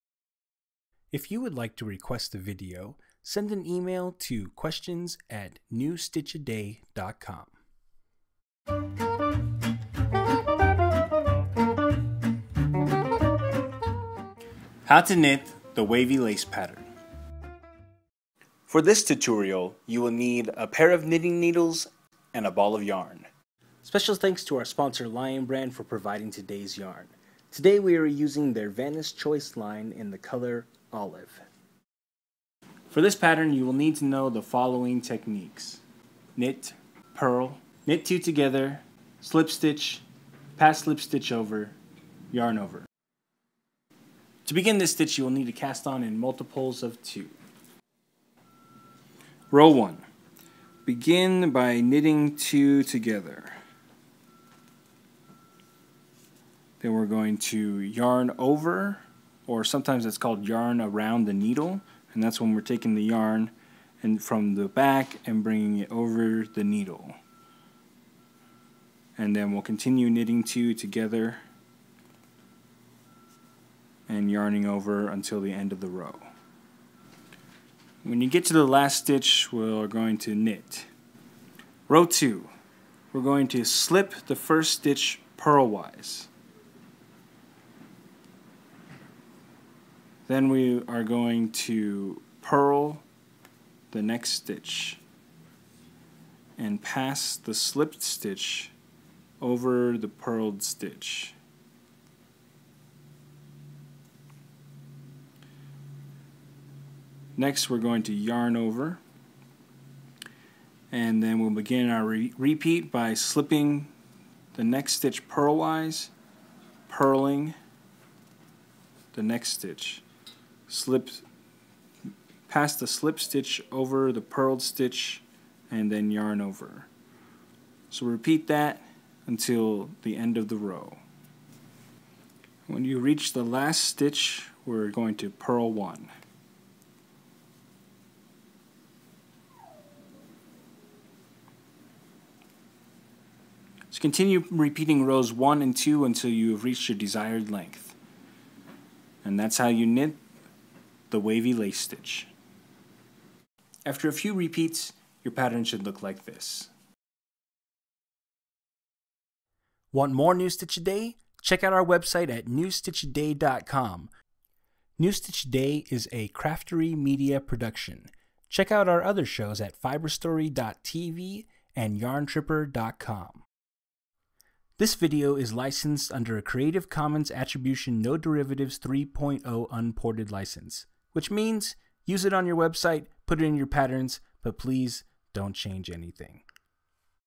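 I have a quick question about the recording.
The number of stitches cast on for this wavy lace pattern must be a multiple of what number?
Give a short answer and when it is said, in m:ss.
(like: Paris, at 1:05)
2, at 0:46.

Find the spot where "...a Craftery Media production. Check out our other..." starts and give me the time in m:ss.
2:46.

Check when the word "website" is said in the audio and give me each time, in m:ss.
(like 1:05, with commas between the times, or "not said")
2:41, 3:02.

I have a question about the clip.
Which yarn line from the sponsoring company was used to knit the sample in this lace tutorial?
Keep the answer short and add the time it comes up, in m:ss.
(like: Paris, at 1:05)
Vanna's Choice, at 0:28.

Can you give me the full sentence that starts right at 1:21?
Row 2, we're going to slip the first stitch purlwise.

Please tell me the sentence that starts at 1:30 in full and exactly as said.
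Then we are going to purl the next stitch and pass the slipped stitch over the purled stitch.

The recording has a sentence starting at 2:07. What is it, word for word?
So repeat that until the end of the row.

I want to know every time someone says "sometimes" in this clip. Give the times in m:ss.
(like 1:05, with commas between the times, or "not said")
0:59.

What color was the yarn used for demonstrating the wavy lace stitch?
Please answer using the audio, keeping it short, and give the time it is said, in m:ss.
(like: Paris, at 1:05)
Olive, at 0:30.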